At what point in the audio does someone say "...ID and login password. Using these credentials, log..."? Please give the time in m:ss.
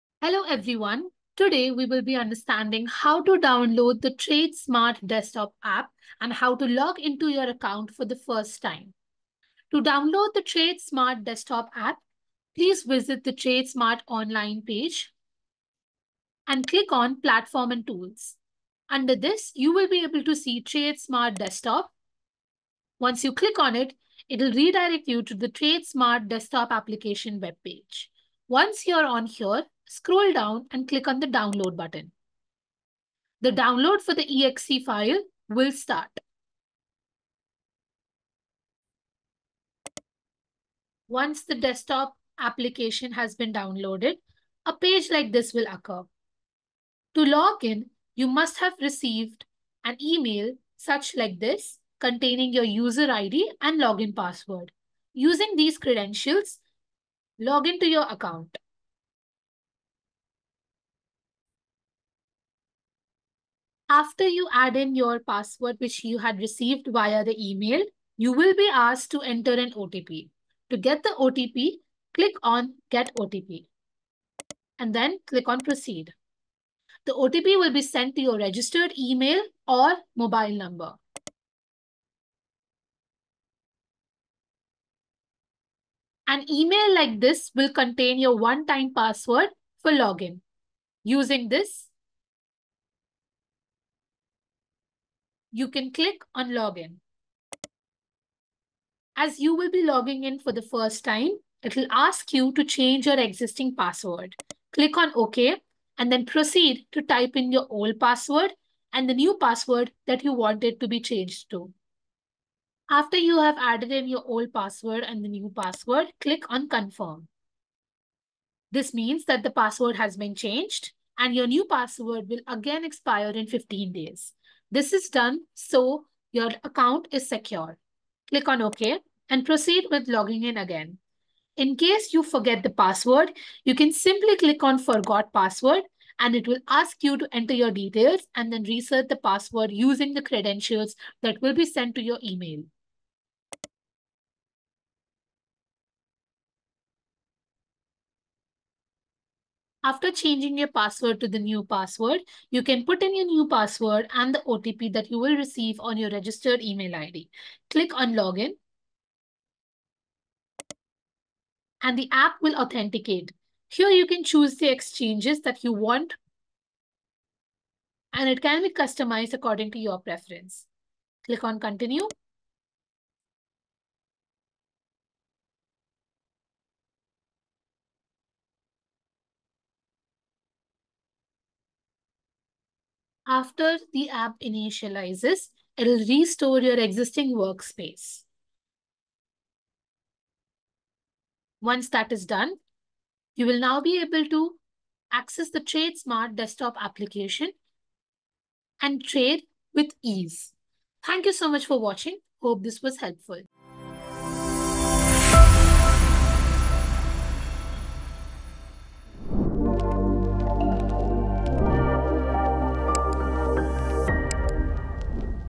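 0:53.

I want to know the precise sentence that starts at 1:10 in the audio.
To get the OTP, click on Get OTP and then click on Proceed.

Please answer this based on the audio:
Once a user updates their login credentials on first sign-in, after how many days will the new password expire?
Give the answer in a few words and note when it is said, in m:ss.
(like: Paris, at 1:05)
15, at 2:03.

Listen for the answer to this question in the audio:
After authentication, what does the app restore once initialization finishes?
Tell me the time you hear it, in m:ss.
3:06.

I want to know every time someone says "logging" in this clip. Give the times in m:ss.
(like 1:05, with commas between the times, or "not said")
1:39, 2:10.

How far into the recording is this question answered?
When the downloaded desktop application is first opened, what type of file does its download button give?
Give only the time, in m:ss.
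0:34.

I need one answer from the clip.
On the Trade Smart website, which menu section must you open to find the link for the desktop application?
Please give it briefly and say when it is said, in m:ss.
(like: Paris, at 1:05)
Platform and tools, at 0:17.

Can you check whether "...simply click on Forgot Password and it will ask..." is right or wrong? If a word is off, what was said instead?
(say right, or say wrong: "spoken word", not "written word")
right.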